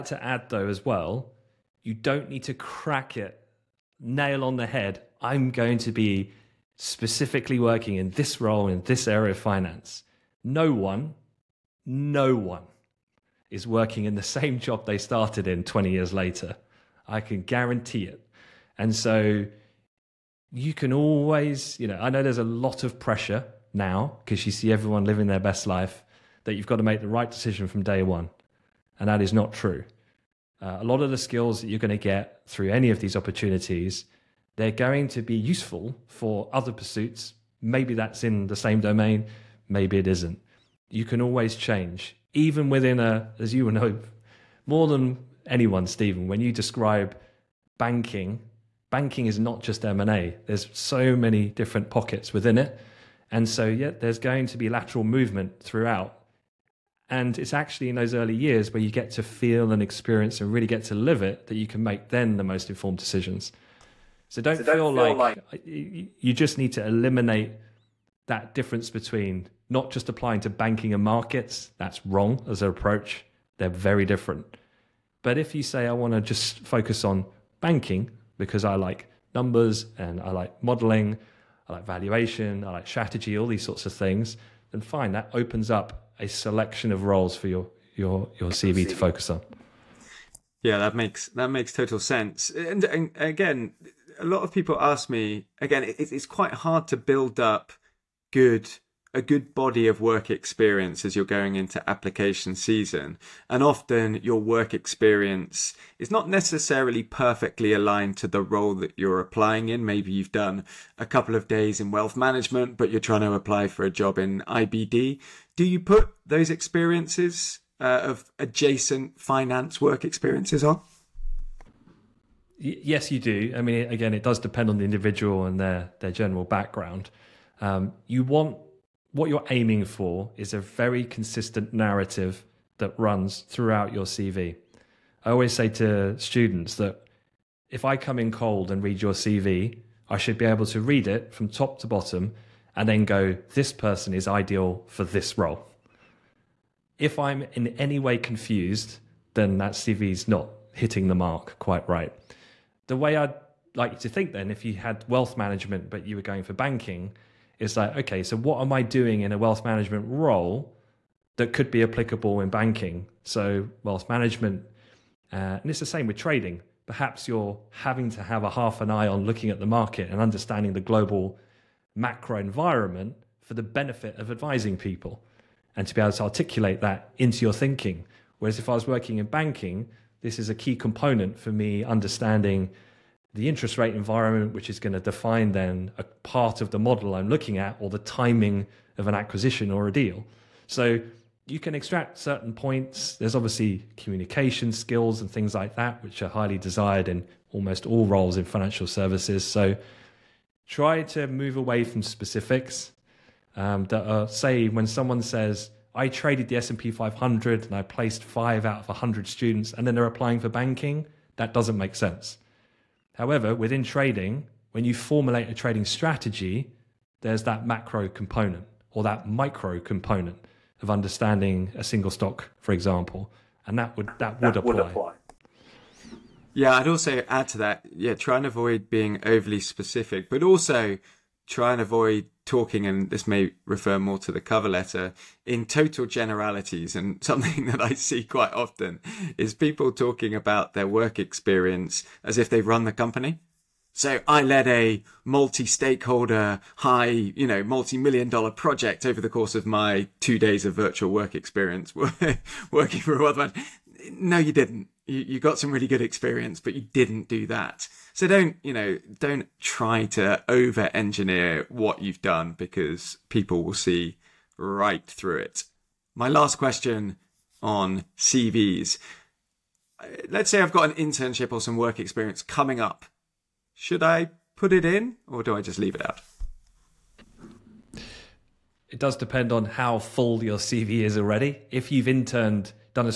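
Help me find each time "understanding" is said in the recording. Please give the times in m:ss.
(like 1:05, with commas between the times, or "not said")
2:50, 3:01, 3:40.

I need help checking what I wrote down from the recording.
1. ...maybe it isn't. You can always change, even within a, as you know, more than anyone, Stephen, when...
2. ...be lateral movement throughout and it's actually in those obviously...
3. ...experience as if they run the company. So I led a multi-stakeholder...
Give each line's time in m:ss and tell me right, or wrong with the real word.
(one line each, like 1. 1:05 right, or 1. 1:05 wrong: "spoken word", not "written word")
1. 0:39 right
2. 0:54 wrong: "early", not "obviously"
3. 4:01 right.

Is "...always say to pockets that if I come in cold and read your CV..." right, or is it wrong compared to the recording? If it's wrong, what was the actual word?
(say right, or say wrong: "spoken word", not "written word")
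wrong: "students", not "pockets".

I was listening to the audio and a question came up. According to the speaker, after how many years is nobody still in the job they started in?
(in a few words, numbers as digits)
20.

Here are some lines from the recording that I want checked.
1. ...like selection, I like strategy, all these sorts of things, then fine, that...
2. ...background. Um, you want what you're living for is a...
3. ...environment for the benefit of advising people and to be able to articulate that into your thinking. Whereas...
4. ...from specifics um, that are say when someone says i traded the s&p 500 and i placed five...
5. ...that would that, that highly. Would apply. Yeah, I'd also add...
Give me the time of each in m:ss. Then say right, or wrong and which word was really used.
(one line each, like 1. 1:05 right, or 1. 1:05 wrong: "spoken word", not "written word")
1. 1:21 wrong: "valuation", not "selection"
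2. 2:06 wrong: "aiming", not "living"
3. 2:52 right
4. 3:21 right
5. 3:43 wrong: "apply", not "highly".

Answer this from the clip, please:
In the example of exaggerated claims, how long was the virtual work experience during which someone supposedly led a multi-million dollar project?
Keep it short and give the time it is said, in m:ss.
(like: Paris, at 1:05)
2 days, at 4:10.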